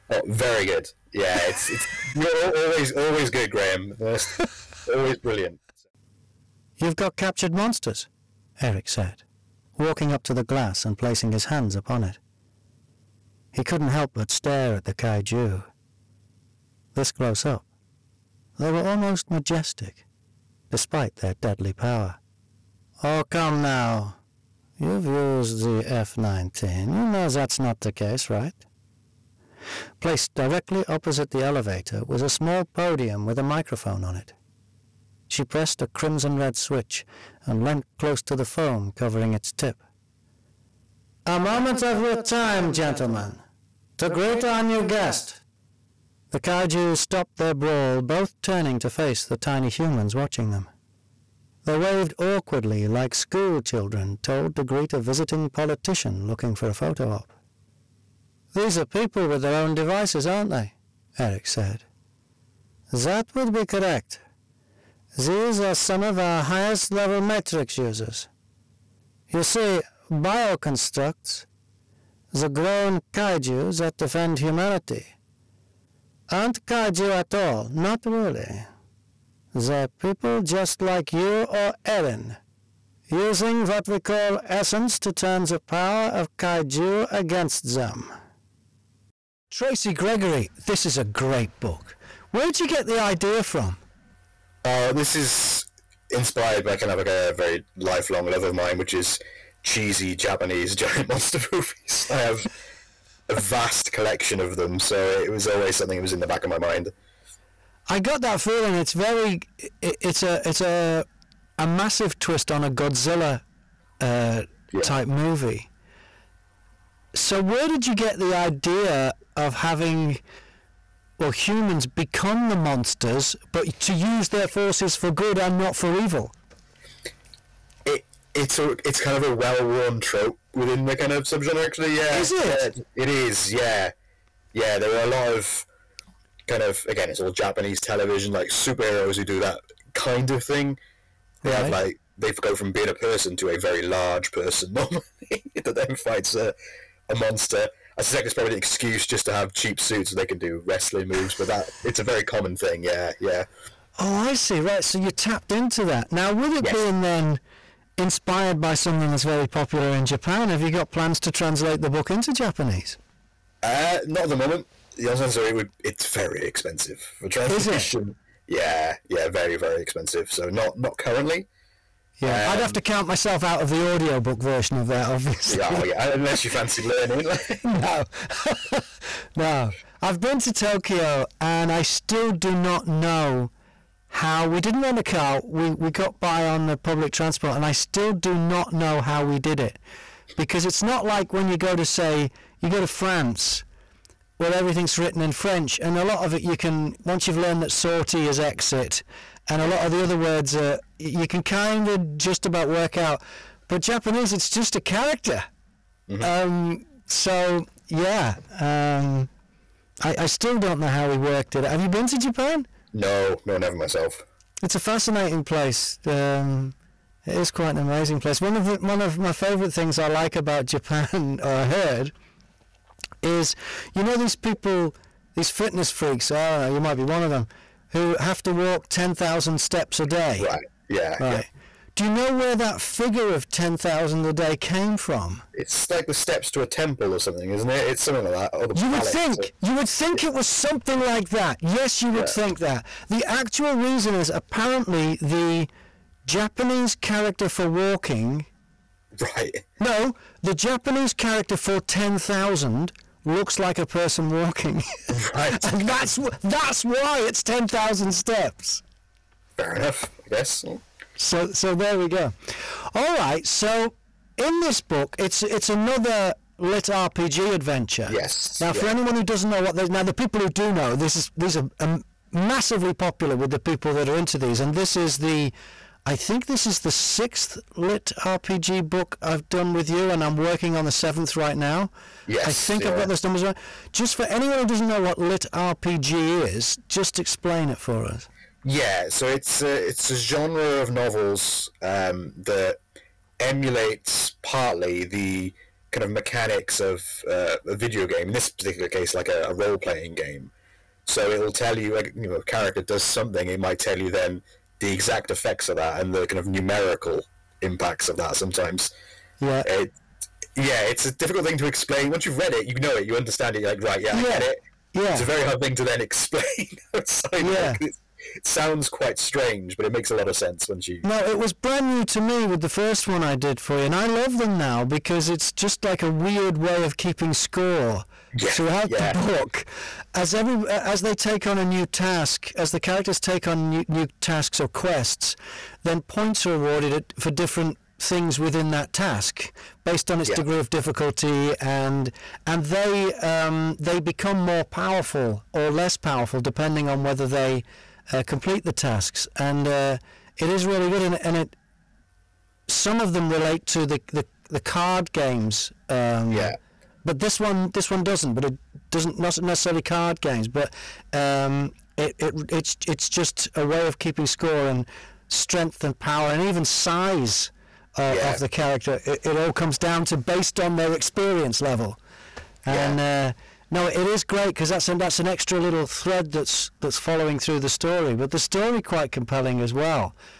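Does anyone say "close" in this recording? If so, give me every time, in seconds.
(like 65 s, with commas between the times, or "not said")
17 s, 37 s.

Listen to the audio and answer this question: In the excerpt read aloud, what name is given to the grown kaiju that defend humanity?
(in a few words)
Bioconstructs.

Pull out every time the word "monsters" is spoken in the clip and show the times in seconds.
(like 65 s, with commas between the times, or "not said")
7 s, 101 s, 122 s, 147 s.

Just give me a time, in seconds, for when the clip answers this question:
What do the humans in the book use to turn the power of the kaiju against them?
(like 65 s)
84 s.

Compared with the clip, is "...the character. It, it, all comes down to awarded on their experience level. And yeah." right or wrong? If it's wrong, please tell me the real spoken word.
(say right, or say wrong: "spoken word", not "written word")
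wrong: "based", not "awarded".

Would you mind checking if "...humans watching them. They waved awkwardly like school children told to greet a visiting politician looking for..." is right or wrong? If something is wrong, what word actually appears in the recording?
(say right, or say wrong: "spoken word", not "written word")
right.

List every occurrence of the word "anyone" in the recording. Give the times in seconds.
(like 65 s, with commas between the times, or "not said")
268 s, 284 s.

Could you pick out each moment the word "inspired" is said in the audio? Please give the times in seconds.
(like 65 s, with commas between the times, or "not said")
96 s, 157 s.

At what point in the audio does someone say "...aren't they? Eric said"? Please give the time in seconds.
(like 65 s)
60 s.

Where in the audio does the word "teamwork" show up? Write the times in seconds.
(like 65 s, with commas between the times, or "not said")
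not said.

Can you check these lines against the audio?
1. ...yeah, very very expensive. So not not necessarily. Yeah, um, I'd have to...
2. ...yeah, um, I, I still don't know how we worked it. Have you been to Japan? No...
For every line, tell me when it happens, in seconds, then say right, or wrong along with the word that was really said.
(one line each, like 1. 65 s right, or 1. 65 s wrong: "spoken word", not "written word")
1. 169 s wrong: "currently", not "necessarily"
2. 207 s right.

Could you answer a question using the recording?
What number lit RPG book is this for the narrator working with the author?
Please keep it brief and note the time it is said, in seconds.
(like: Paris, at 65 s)
Sixth, at 276 s.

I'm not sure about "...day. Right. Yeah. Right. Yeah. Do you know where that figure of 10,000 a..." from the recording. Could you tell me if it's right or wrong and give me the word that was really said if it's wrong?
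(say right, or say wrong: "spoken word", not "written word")
right.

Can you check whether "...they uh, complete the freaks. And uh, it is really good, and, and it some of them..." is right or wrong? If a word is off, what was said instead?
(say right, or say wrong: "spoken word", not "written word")
wrong: "tasks", not "freaks".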